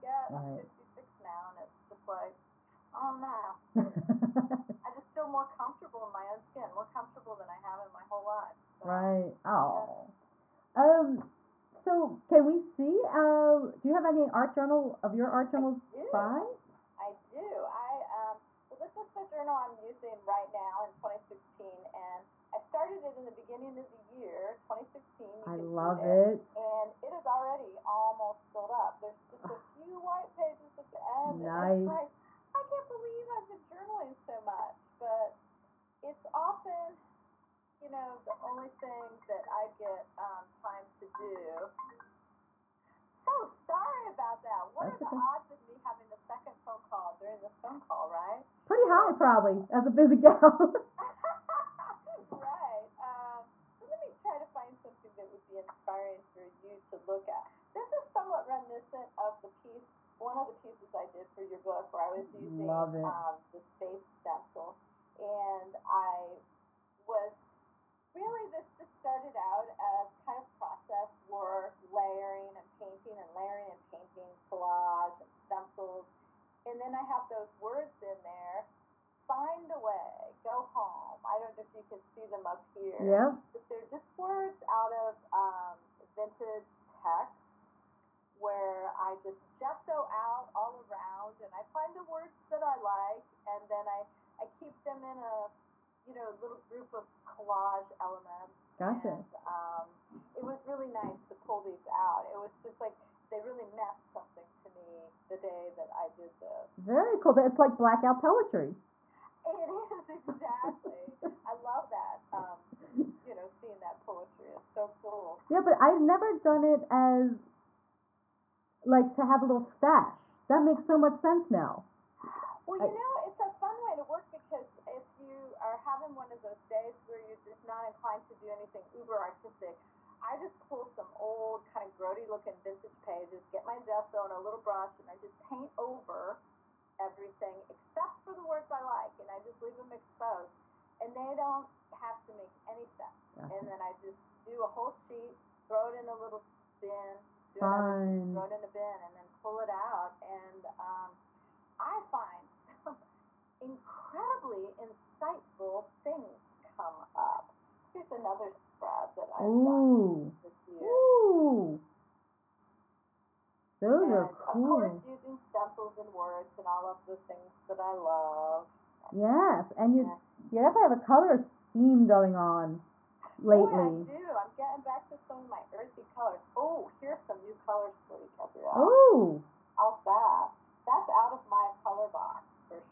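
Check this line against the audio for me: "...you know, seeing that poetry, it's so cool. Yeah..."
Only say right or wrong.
right.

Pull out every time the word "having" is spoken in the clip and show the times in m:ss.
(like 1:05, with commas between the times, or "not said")
0:45, 2:05.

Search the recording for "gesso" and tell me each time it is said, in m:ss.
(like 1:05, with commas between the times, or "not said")
1:29, 2:13.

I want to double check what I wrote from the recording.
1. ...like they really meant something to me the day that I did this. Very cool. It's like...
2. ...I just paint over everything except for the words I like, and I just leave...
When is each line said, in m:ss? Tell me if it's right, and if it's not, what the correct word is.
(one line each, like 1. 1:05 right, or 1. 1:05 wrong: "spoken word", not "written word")
1. 1:42 right
2. 2:15 right.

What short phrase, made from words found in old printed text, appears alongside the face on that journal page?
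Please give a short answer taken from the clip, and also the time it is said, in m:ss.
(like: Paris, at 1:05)
Find a way, go home, at 1:19.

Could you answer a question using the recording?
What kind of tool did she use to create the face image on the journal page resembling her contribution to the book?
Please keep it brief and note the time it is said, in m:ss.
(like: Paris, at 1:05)
Stencil, at 1:04.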